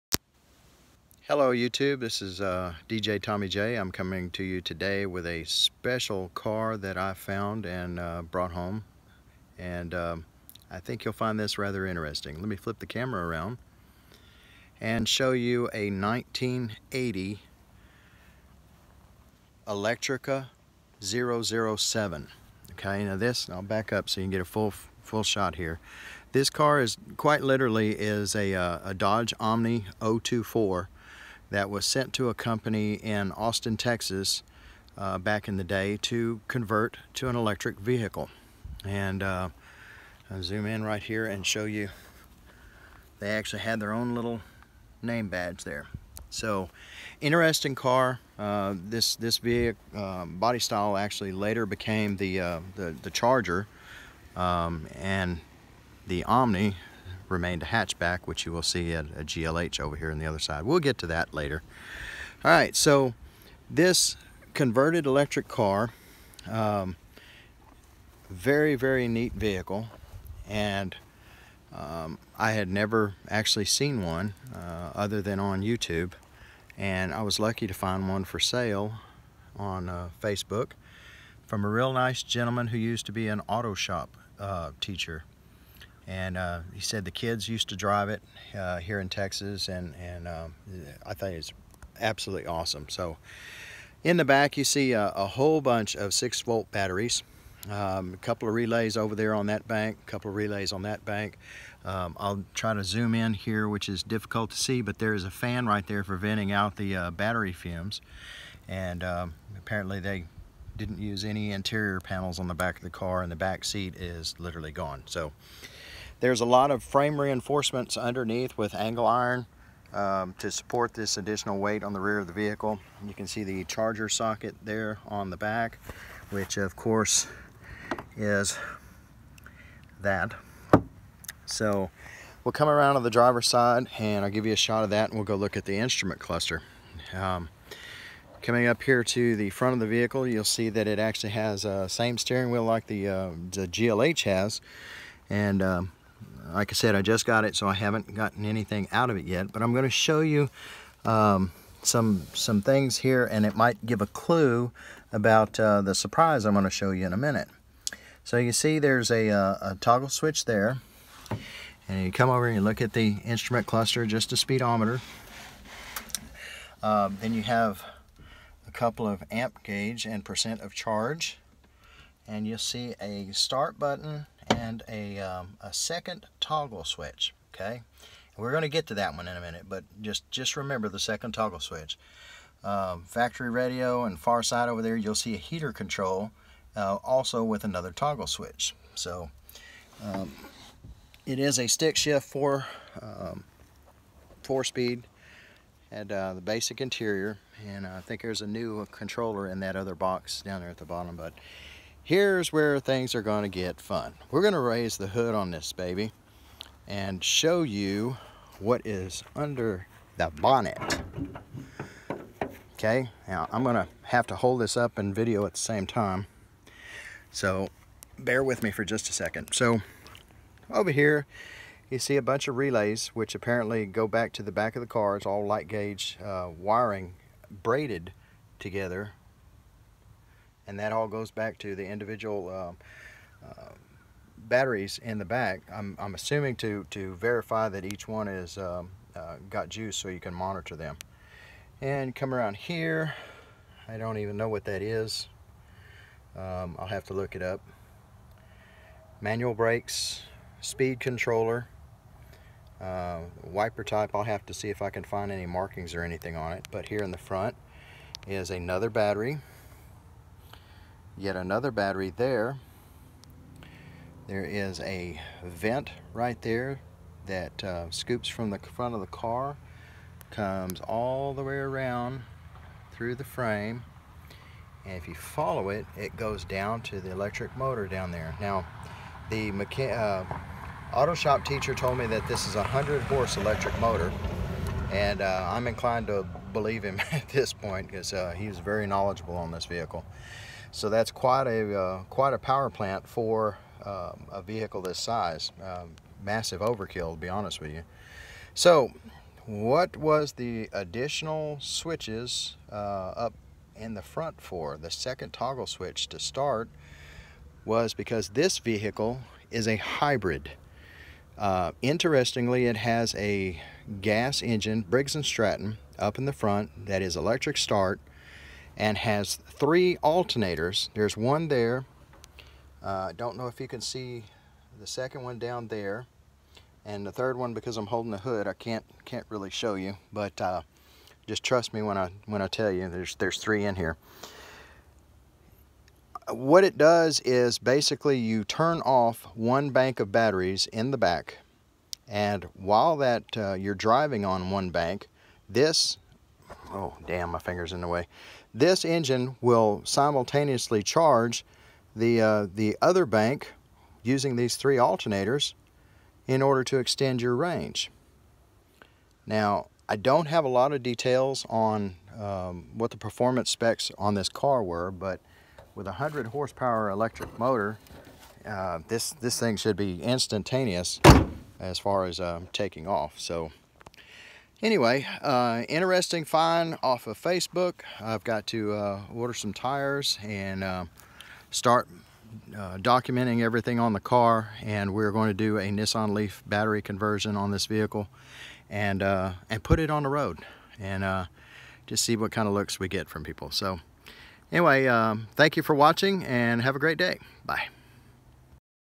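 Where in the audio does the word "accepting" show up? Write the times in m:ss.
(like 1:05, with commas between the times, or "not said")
not said.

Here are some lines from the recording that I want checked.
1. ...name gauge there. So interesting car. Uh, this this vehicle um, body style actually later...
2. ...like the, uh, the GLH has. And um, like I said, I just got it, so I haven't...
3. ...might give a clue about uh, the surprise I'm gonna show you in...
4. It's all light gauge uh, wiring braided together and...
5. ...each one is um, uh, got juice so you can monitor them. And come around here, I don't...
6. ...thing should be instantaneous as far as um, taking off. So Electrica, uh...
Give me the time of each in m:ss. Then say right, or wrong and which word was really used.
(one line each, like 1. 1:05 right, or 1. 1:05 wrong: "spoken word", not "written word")
1. 0:45 wrong: "badge", not "gauge"
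2. 2:22 right
3. 2:33 right
4. 3:45 right
5. 3:57 right
6. 6:09 wrong: "Anyway", not "Electrica".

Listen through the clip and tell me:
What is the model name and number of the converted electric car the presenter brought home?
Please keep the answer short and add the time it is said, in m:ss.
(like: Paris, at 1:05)
Electrica 007, at 0:19.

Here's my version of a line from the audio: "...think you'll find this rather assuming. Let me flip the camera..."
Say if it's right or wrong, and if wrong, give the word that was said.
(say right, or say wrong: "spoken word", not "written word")
wrong: "interesting", not "assuming".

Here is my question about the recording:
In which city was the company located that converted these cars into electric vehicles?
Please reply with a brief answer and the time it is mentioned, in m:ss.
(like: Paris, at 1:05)
Austin, Texas, at 0:33.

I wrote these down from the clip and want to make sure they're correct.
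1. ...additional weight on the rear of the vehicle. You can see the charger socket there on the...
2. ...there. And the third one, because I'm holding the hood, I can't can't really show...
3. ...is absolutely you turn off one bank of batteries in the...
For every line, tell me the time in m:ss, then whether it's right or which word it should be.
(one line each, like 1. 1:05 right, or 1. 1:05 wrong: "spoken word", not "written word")
1. 2:01 right
2. 5:25 right
3. 5:37 wrong: "basically", not "absolutely".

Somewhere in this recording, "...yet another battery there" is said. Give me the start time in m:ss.
4:21.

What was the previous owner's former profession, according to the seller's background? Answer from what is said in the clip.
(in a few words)
Auto shop teacher.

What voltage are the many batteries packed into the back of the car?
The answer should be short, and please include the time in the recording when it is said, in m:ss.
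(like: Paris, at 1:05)
6 volt, at 1:36.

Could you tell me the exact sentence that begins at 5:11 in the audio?
Uh, interestingly, it has a gas engine, Briggs & Stratton, up in the front that is electric start and has three alternators.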